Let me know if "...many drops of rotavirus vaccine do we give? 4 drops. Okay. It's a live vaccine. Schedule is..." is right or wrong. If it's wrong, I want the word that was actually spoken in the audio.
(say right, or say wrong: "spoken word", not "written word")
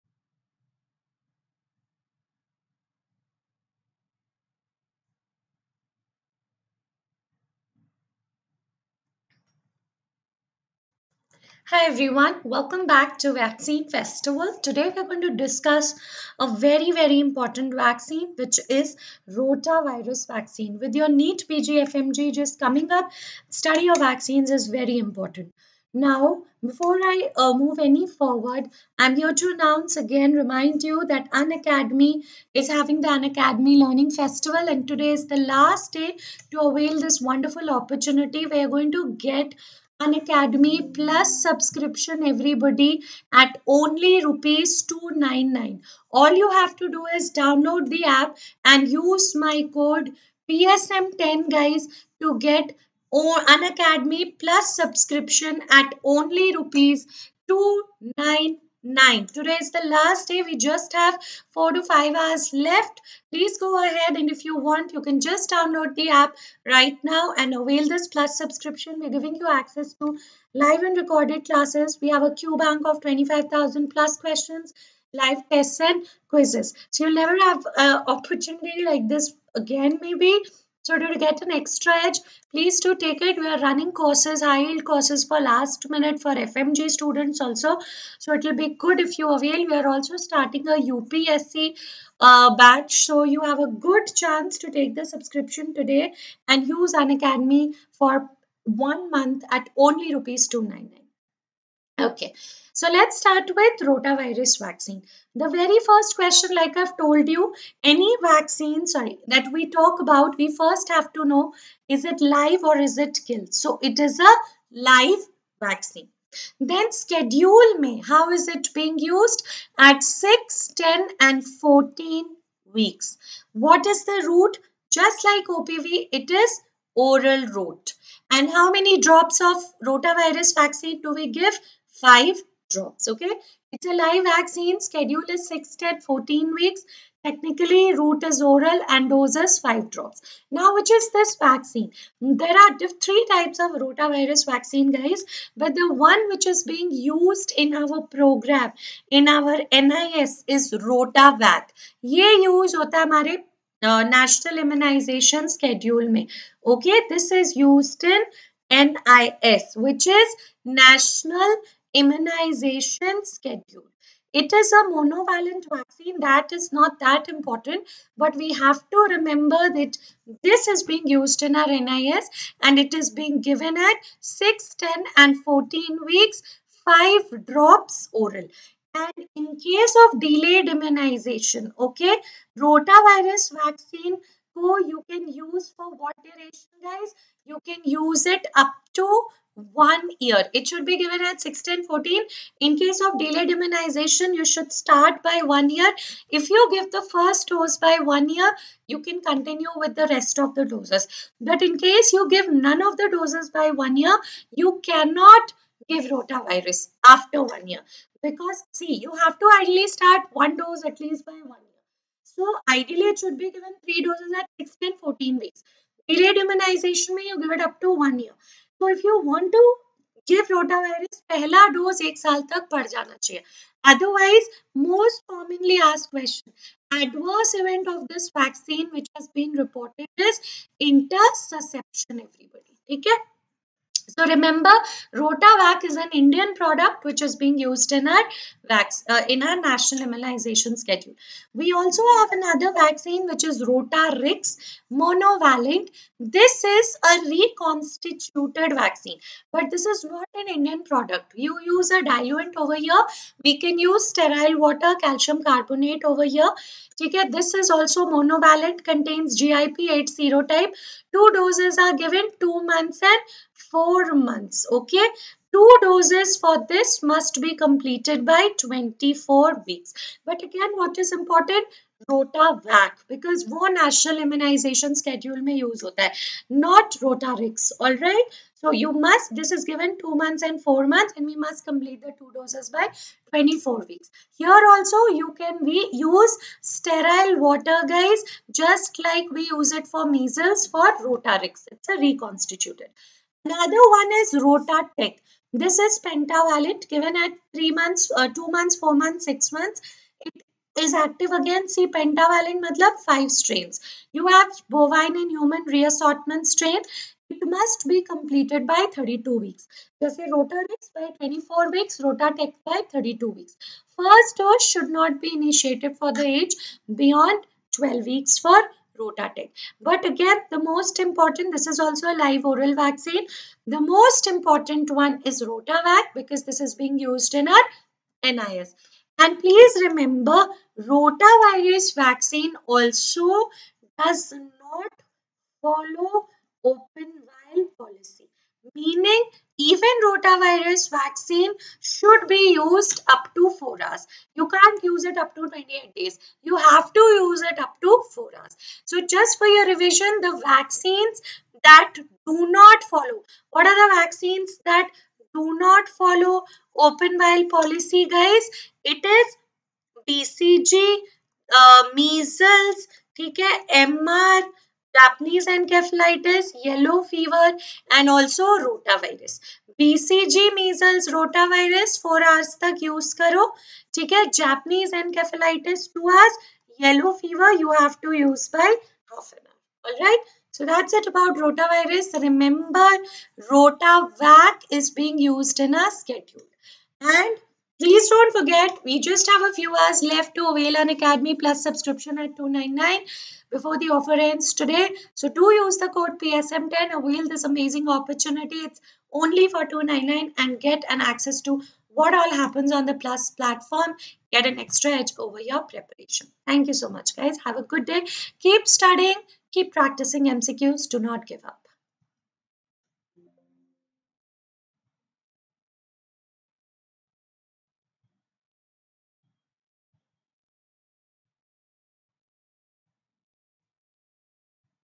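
wrong: "5", not "4".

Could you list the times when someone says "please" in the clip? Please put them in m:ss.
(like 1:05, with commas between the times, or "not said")
1:03, 1:22, 5:29, 6:27.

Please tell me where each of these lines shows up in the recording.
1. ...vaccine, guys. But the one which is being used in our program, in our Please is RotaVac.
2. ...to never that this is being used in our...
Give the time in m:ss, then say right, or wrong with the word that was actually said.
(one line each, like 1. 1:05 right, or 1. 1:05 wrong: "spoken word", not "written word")
1. 2:24 wrong: "NIS", not "Please"
2. 2:48 wrong: "remember", not "never".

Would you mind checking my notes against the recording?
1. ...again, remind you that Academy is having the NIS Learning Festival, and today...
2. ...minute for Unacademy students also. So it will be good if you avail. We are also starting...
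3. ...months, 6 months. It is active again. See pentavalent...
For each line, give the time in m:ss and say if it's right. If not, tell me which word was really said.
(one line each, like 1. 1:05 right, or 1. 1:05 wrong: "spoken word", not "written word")
1. 0:29 wrong: "Academy", not "NIS"
2. 1:25 wrong: "FMG", not "Unacademy"
3. 4:58 right.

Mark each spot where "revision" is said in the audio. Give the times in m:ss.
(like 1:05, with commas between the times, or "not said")
5:49.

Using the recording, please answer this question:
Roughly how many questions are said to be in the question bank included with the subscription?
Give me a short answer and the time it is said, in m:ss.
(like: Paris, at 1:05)
25,000 plus, at 1:13.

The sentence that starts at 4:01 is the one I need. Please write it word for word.
We also have another vaccine which is Rotarix monovalent.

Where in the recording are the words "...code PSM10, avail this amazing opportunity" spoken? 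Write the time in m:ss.
6:35.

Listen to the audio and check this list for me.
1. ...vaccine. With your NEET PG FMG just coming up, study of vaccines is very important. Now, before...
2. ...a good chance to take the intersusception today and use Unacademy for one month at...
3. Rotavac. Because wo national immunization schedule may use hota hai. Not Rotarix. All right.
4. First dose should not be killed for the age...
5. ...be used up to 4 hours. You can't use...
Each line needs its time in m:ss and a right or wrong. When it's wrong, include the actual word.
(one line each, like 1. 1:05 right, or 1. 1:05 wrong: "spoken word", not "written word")
1. 0:20 right
2. 1:33 wrong: "subscription", not "intersusception"
3. 4:32 right
4. 5:13 wrong: "initiated", not "killed"
5. 5:42 right.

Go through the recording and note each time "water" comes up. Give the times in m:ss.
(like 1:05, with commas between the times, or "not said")
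4:14, 4:47.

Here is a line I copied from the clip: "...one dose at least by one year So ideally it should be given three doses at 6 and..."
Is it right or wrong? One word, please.
right.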